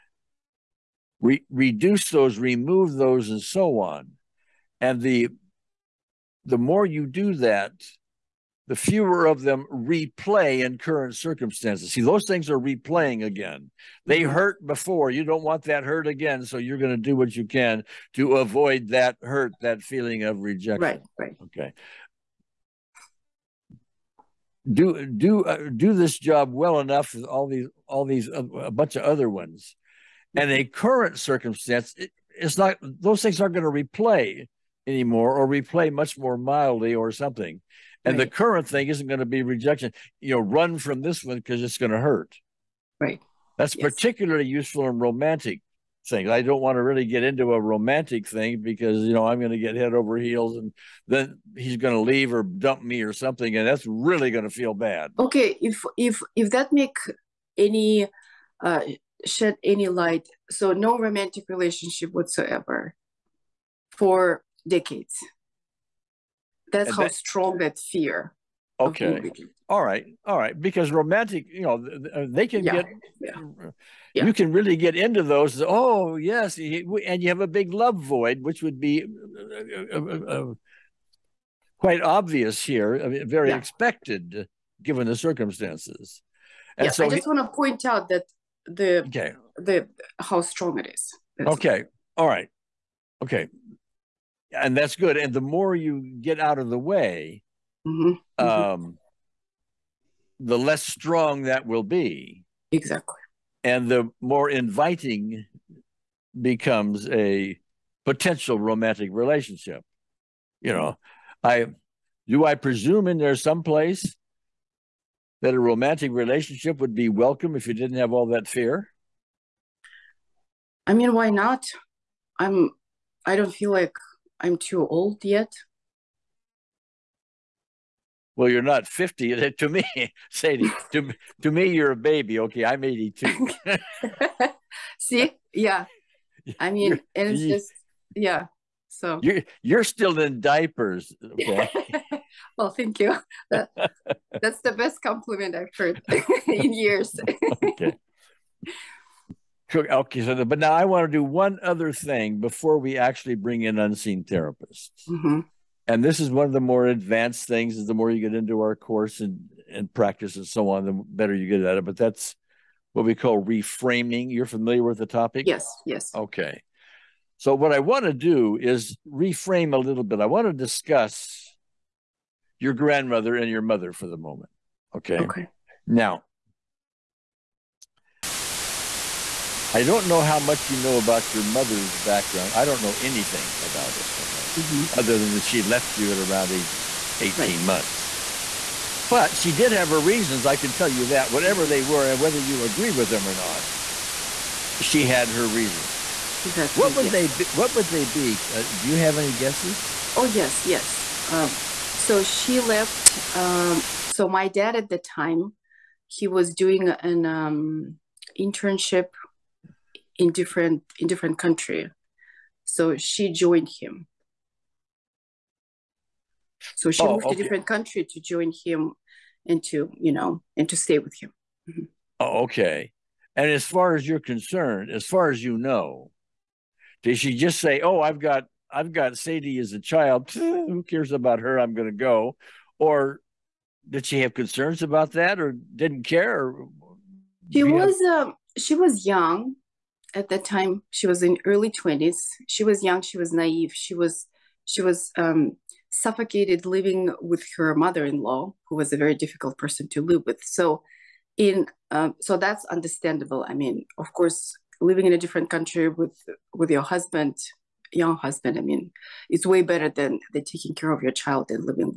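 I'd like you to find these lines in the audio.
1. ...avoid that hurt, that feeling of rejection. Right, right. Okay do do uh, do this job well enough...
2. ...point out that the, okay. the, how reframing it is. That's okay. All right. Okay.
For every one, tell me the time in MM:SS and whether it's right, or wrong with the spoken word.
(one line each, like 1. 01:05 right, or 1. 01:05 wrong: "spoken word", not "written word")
1. 00:18 right
2. 01:27 wrong: "strong", not "reframing".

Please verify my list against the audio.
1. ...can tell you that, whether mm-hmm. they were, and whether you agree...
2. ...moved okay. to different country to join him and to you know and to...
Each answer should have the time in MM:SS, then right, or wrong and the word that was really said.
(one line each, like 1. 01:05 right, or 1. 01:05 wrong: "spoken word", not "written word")
1. 03:10 wrong: "whatever", not "whether"
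2. 03:37 right.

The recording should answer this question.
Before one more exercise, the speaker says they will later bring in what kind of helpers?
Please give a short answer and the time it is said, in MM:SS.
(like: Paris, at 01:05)
unseen therapists, at 02:33.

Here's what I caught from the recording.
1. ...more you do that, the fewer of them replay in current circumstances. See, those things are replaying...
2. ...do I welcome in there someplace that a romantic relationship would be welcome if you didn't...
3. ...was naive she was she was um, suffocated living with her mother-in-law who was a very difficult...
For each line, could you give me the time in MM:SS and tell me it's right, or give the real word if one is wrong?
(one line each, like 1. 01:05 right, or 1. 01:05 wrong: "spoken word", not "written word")
1. 00:06 right
2. 01:52 wrong: "presume", not "welcome"
3. 04:03 right.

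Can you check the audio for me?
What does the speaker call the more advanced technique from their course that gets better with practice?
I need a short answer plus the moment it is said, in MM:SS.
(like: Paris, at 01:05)
reframing, at 02:43.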